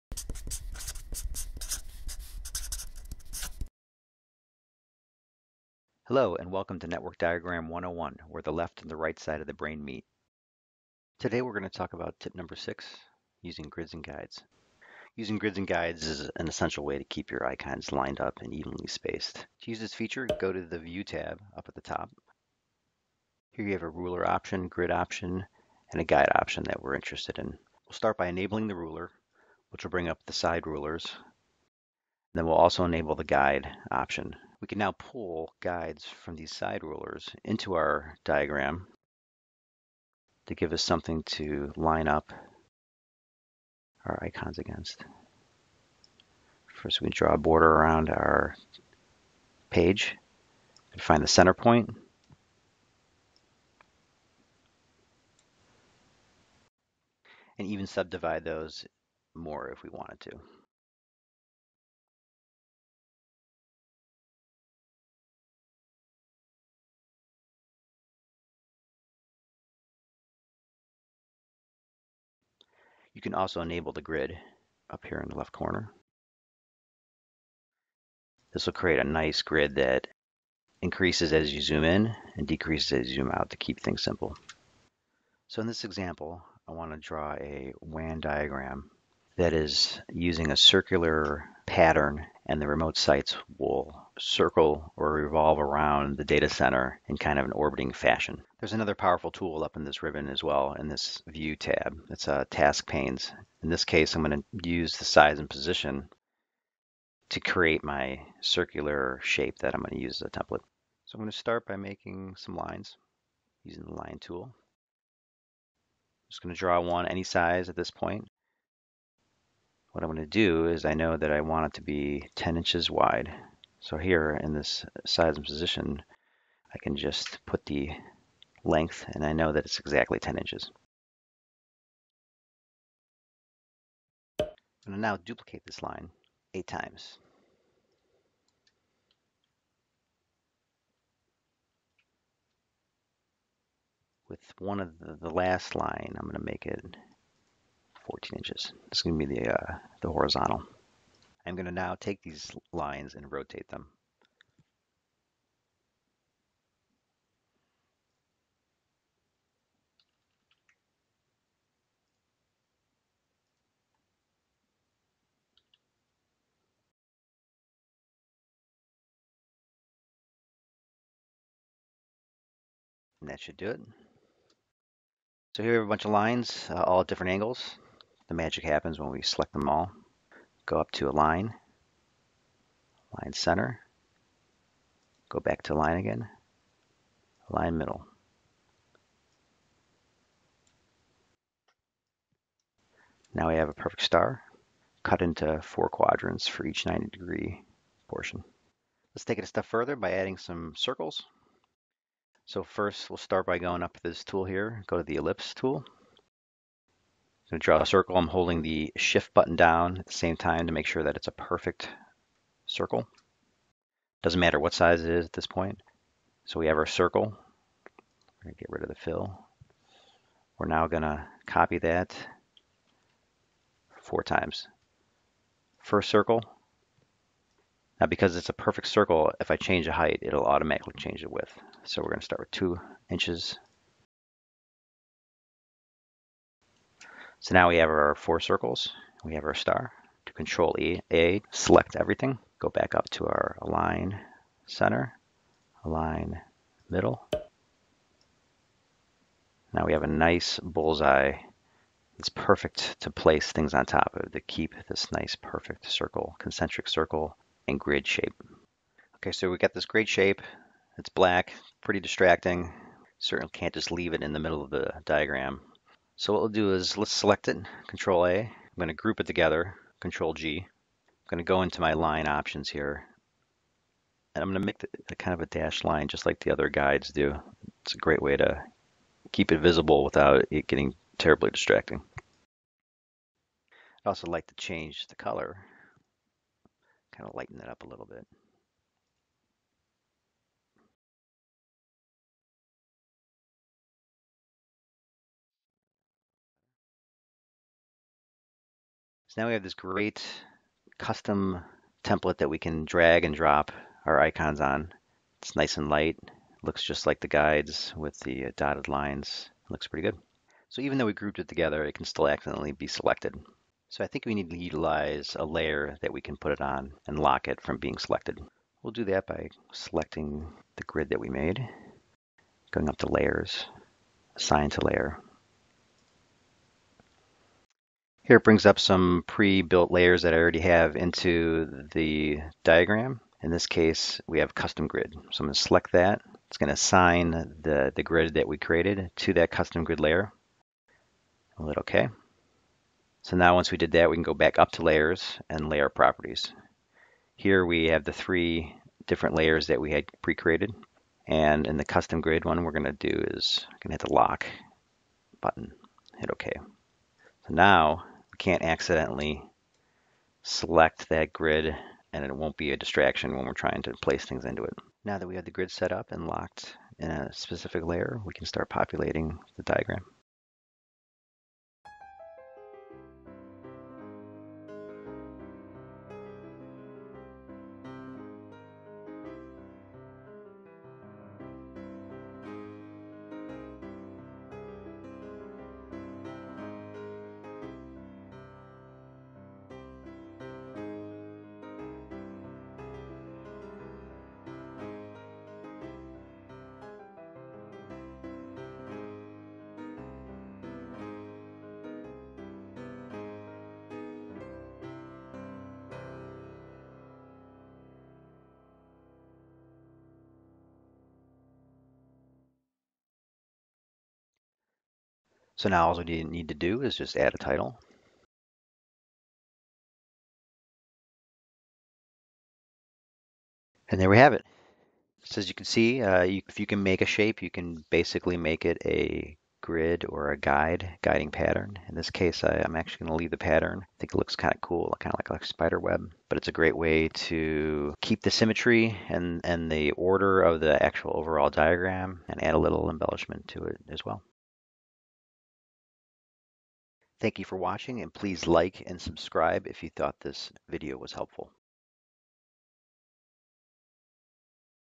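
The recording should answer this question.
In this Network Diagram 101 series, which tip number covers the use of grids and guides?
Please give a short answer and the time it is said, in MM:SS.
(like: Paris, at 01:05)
6, at 00:12.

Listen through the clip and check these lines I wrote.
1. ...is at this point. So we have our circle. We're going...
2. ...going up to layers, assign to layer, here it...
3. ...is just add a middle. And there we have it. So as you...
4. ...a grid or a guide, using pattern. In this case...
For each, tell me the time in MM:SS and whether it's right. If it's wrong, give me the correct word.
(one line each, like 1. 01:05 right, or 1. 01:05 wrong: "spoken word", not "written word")
1. 03:35 right
2. 05:22 right
3. 06:56 wrong: "title", not "middle"
4. 07:08 wrong: "guiding", not "using".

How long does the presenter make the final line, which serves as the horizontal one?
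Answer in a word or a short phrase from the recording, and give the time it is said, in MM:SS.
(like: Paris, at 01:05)
14 inches, at 02:28.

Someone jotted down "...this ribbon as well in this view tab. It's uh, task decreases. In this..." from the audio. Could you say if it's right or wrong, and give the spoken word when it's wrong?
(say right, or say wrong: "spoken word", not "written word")
wrong: "panes", not "decreases".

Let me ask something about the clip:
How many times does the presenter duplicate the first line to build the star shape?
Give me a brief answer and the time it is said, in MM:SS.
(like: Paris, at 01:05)
8, at 02:16.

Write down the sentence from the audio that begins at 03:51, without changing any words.
So we're going to start with two inches So now we have our four circles, we have our star.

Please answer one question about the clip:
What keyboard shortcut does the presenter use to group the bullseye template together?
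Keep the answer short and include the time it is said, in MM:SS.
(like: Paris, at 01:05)
Control G, at 04:29.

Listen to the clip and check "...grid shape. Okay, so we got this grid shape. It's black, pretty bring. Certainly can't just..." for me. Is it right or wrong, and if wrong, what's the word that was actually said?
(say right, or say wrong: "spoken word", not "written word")
wrong: "distracting", not "bring".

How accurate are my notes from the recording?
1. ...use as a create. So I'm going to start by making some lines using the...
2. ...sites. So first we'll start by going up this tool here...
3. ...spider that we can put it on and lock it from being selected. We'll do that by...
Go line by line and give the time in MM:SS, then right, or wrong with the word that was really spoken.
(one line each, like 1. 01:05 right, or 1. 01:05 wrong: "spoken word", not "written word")
1. 01:50 wrong: "template", not "create"
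2. 03:20 wrong: "circles", not "sites"
3. 05:15 wrong: "layer", not "spider".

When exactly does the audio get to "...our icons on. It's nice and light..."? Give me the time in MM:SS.
05:04.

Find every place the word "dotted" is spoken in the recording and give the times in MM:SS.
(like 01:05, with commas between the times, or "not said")
05:08.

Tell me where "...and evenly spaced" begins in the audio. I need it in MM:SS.
00:18.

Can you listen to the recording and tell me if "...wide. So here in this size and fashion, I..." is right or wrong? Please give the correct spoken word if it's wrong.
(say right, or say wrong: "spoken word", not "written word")
wrong: "position", not "fashion".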